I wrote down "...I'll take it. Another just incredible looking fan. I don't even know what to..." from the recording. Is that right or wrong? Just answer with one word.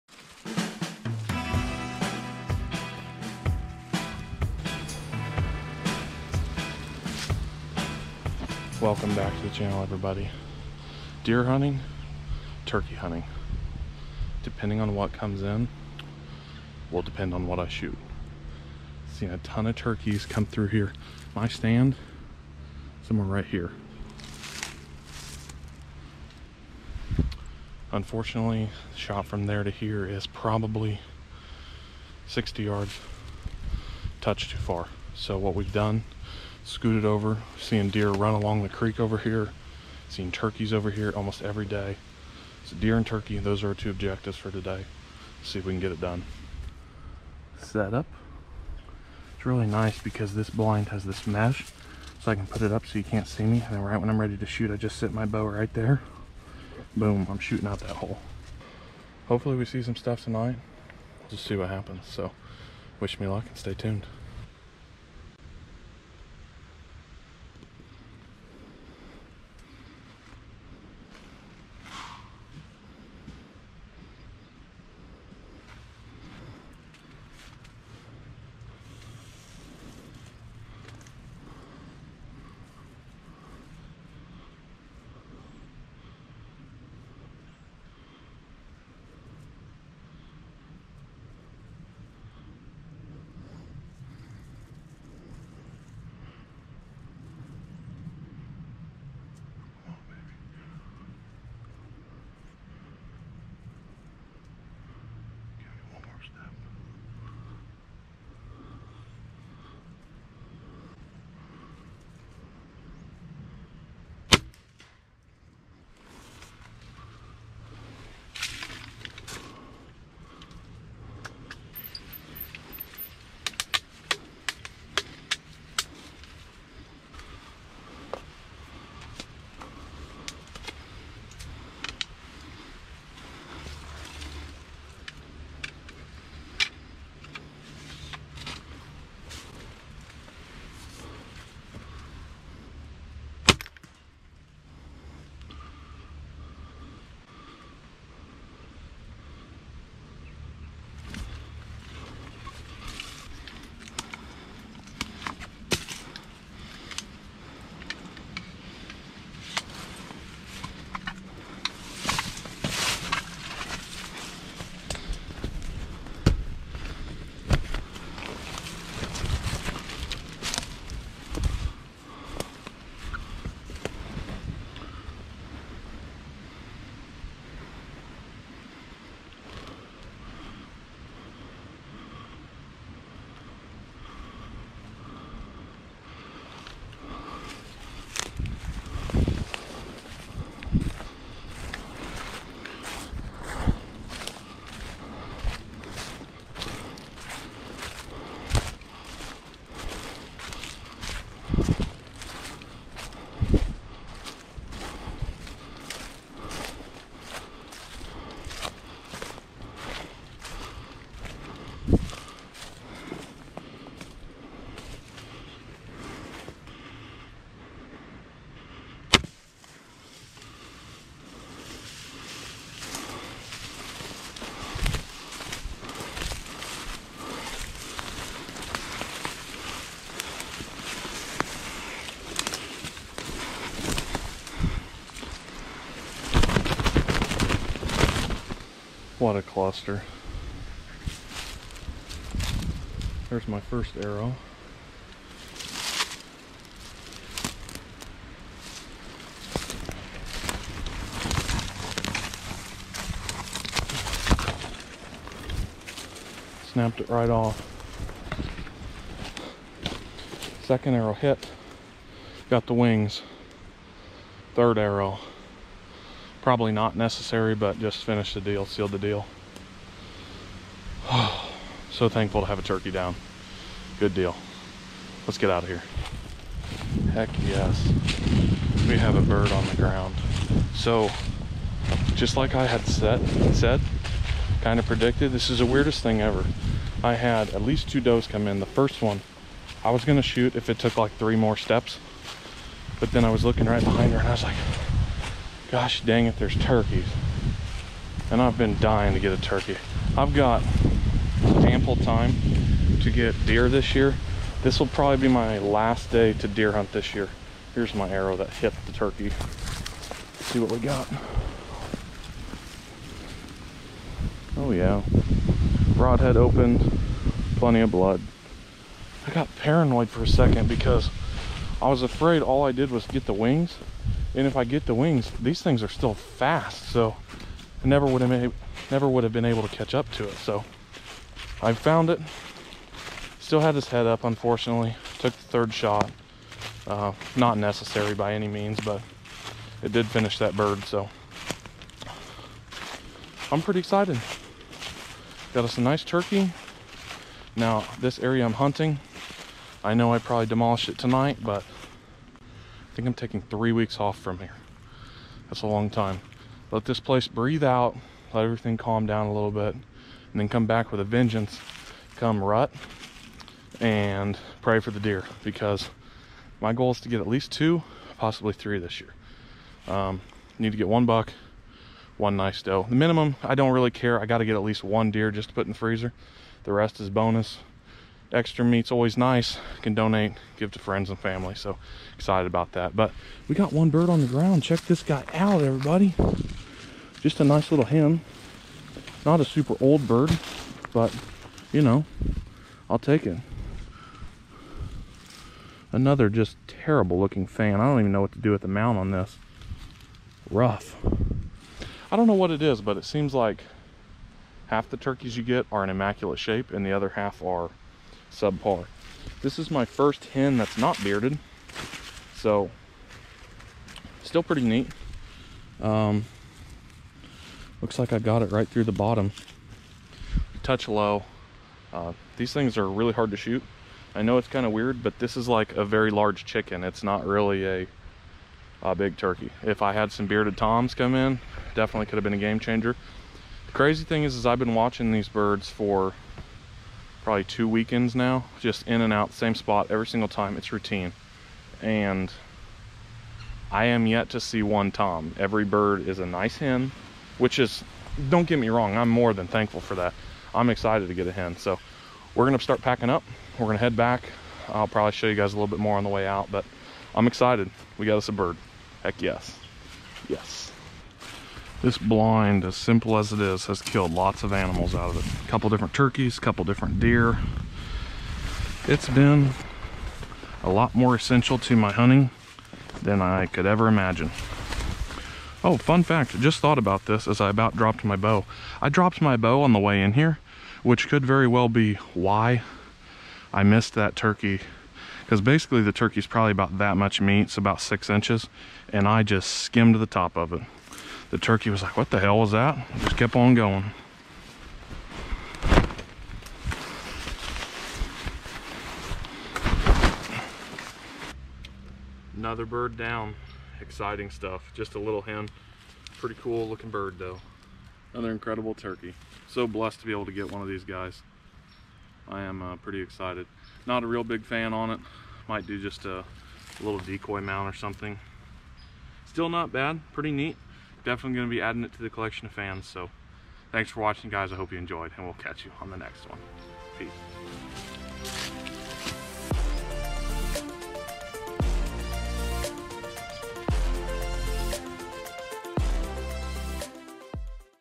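wrong.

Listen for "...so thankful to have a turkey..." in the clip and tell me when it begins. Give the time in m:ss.
4:31.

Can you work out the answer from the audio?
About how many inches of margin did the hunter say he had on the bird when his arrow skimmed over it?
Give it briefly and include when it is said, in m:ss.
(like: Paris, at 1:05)
6 inches, at 8:07.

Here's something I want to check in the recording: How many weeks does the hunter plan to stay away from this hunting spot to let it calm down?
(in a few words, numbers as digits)
3 weeks.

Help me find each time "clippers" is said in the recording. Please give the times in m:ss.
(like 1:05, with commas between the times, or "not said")
not said.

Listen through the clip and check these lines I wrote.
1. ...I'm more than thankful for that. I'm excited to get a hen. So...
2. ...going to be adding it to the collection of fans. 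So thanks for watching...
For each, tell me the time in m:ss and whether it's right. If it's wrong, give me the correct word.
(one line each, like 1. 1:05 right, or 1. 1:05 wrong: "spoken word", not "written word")
1. 7:28 right
2. 8:41 right.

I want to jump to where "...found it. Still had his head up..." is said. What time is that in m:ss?
5:31.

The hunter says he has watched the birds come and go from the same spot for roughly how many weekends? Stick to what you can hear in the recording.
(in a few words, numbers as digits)
2 weekends.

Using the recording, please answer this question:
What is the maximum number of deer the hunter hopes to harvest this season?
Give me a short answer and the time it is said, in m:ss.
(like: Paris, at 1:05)
3, at 6:08.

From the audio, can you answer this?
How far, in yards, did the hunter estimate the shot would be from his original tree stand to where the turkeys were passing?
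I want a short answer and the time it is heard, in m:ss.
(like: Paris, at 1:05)
60 yards, at 0:32.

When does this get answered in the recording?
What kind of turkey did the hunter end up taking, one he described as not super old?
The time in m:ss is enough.
6:27.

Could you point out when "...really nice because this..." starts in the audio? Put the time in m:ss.
0:49.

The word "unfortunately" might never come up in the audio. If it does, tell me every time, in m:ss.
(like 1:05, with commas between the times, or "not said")
0:27, 5:34.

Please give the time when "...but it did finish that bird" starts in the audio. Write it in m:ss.
5:38.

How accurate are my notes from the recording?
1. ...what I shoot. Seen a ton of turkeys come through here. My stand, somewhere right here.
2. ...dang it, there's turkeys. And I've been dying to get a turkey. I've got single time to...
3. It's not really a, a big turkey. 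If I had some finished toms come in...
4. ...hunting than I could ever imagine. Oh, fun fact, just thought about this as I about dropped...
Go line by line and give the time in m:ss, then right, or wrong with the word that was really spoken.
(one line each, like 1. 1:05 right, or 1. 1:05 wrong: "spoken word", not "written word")
1. 0:17 right
2. 4:56 wrong: "ample", not "single"
3. 7:06 wrong: "bearded", not "finished"
4. 7:51 right.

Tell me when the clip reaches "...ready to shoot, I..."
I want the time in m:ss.
0:54.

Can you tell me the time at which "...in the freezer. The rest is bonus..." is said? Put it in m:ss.
6:15.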